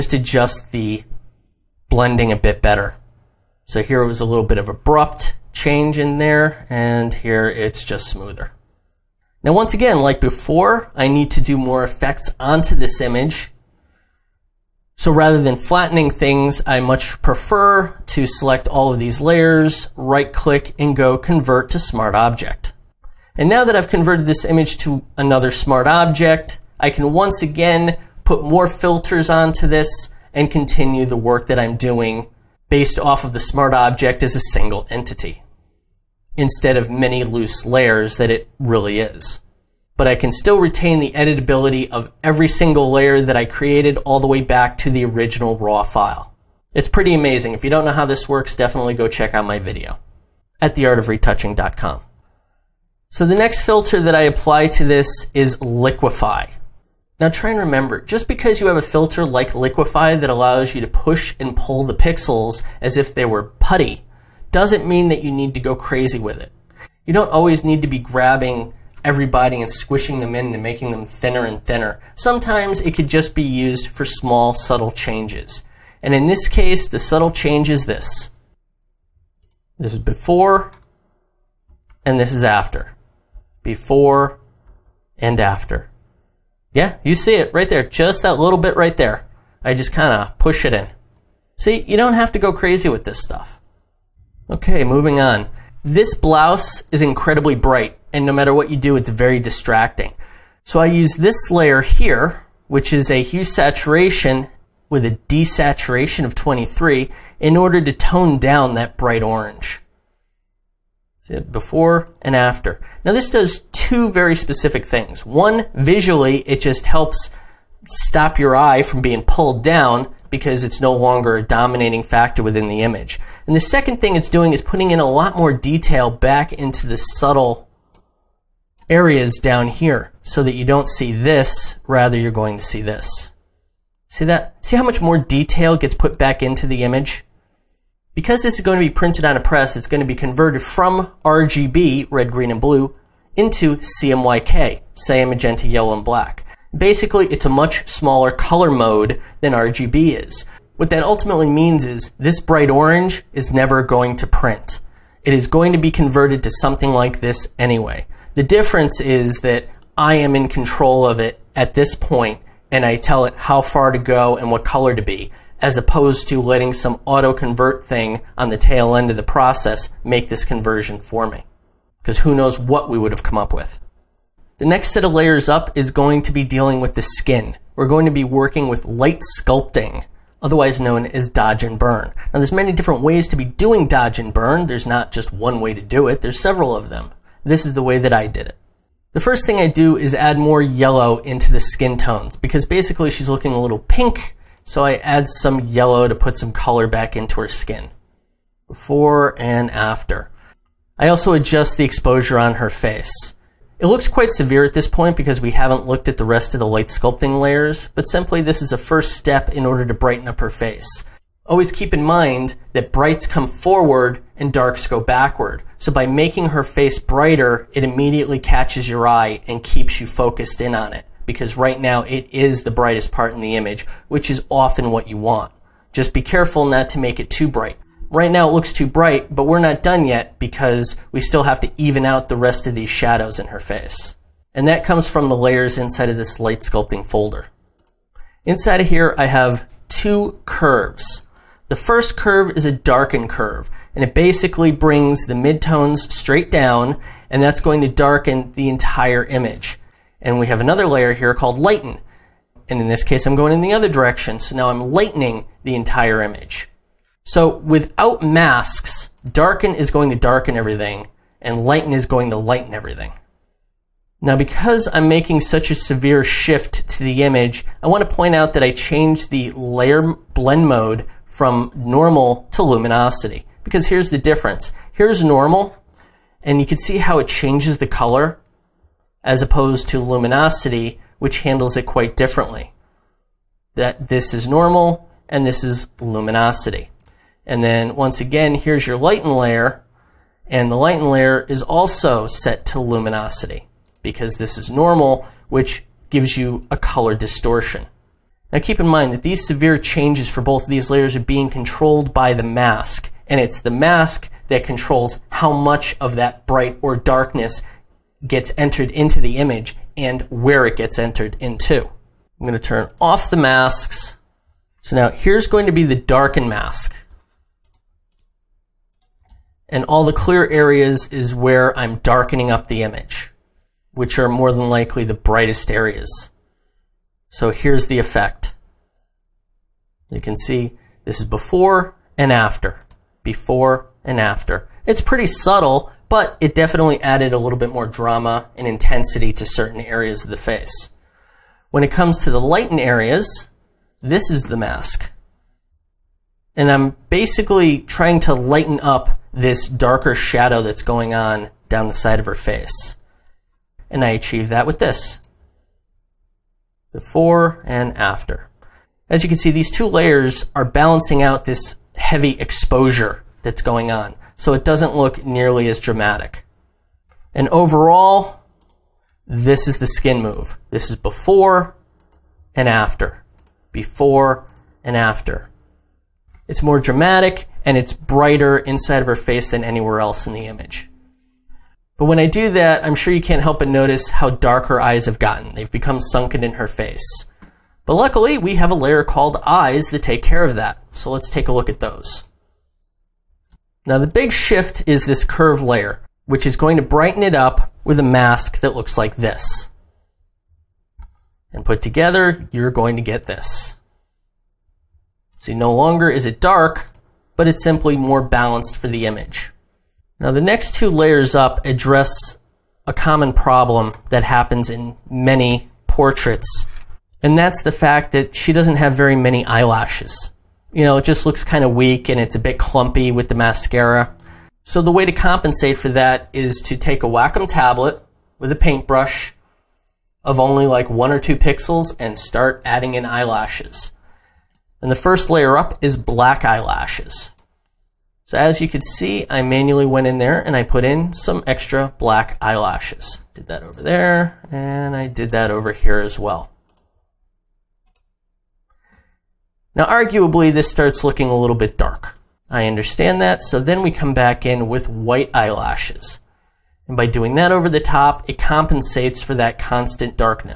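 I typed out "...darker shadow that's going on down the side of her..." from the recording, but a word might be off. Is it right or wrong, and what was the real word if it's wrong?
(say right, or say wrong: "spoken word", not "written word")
right.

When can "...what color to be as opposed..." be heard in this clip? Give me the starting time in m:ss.
2:44.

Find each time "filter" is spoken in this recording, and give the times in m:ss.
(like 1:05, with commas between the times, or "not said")
0:28, 0:53, 0:58.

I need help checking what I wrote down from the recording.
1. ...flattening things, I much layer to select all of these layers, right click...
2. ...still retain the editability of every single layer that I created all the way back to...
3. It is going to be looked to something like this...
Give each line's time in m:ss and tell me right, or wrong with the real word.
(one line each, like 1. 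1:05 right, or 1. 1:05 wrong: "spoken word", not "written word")
1. 0:15 wrong: "prefer", not "layer"
2. 0:40 right
3. 2:35 wrong: "converted", not "looked".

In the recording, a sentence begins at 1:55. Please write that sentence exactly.
One, visually, it just helps stop your eye from being pulled down because it's no longer a dominating factor within the image.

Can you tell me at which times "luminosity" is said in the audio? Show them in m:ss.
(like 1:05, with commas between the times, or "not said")
4:32, 4:39, 4:45, 4:52.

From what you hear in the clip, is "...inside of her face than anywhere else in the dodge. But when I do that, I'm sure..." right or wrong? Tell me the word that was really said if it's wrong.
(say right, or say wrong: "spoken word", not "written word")
wrong: "image", not "dodge".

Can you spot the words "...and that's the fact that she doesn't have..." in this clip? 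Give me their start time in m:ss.
6:57.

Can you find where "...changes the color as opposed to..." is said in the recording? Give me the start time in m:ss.
4:37.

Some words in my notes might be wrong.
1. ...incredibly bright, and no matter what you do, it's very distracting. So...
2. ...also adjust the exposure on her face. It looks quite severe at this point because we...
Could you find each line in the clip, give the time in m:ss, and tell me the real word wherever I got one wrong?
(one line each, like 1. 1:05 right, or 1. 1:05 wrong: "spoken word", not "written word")
1. 1:37 right
2. 3:21 right.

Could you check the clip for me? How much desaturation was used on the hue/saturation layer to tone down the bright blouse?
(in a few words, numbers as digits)
23.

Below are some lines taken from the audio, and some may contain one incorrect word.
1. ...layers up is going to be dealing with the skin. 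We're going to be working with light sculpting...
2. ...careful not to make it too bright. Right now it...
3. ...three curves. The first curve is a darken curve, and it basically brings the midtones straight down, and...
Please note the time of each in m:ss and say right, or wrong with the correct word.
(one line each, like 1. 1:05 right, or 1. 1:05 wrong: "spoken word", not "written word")
1. 2:55 right
2. 3:46 right
3. 3:59 wrong: "two", not "three".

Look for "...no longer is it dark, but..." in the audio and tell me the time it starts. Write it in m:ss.
6:45.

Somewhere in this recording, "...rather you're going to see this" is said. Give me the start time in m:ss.
2:11.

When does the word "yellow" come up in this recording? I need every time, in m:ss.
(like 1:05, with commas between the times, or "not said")
2:25, 3:10, 3:15.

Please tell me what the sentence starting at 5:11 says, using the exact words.
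I'm going to turn off the masks.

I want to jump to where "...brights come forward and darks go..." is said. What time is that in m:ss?
3:32.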